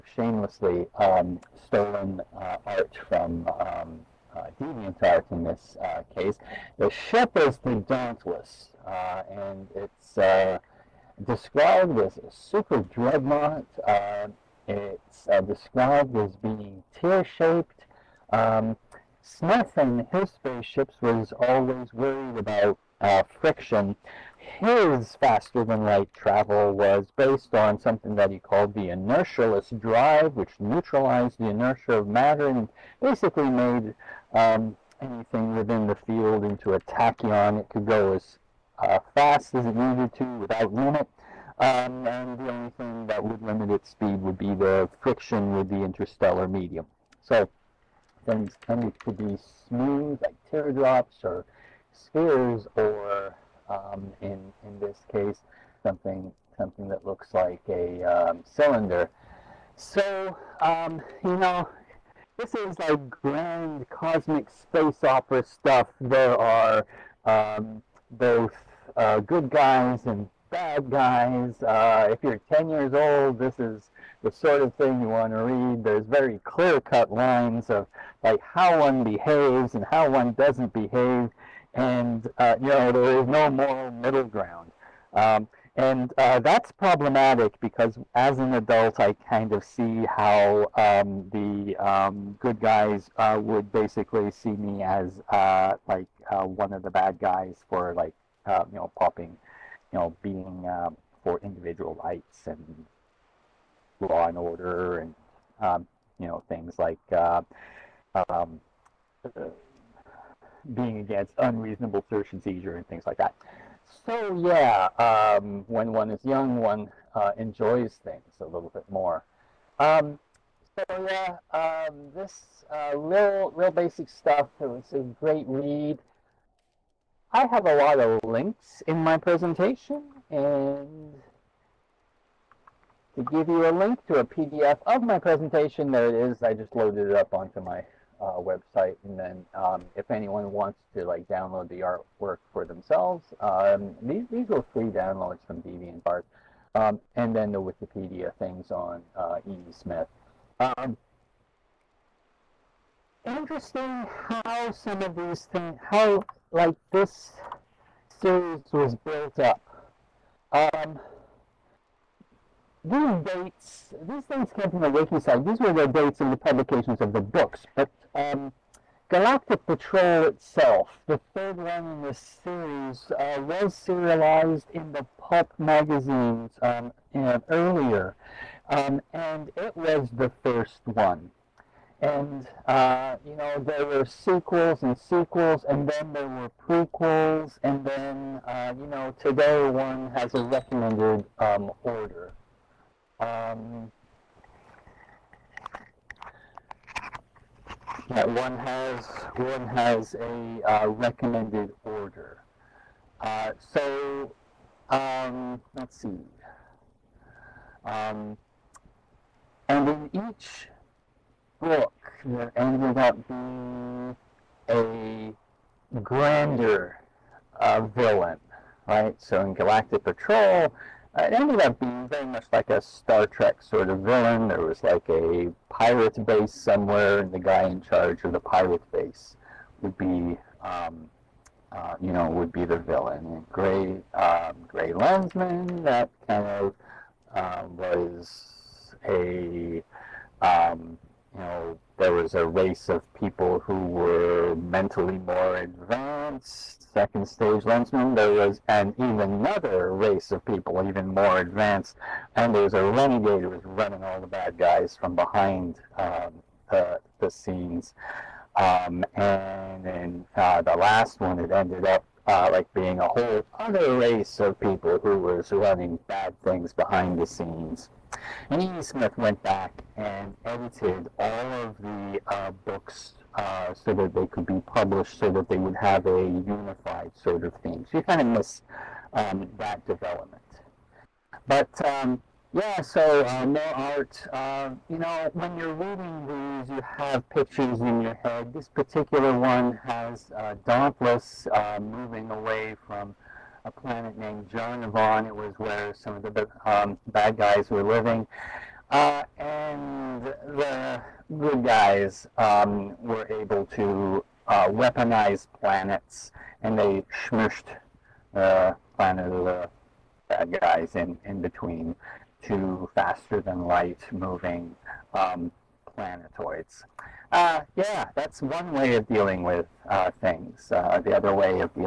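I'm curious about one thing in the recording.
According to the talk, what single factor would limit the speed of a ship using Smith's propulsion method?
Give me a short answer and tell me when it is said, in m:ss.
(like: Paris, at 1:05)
Friction with the interstellar medium, at 0:45.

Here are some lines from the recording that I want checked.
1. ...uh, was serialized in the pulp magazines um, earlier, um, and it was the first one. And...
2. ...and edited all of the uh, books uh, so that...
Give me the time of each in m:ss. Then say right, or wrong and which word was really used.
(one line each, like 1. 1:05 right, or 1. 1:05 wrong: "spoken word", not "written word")
1. 2:53 right
2. 4:29 right.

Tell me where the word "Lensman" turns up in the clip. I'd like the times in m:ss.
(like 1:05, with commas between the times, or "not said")
3:54, 4:07.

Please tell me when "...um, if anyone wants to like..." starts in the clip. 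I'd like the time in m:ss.
2:19.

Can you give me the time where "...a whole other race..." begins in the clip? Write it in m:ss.
4:22.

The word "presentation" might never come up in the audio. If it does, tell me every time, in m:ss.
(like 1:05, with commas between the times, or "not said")
2:09, 2:15.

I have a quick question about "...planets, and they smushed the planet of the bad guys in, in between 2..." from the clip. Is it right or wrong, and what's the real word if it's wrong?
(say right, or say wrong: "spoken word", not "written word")
right.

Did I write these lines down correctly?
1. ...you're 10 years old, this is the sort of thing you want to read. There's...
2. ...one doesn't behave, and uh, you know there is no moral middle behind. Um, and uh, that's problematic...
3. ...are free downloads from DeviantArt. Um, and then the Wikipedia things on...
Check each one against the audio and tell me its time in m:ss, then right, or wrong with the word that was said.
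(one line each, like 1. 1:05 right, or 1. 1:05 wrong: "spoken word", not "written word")
1. 1:12 right
2. 1:20 wrong: "ground", not "behind"
3. 2:24 right.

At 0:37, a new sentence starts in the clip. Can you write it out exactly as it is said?
It could go as uh, fast as it needed to without limit.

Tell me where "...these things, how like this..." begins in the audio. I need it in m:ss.
2:35.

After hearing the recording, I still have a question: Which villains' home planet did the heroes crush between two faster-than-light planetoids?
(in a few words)
Jarnevon.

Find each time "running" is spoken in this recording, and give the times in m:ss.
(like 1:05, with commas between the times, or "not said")
4:13, 4:25.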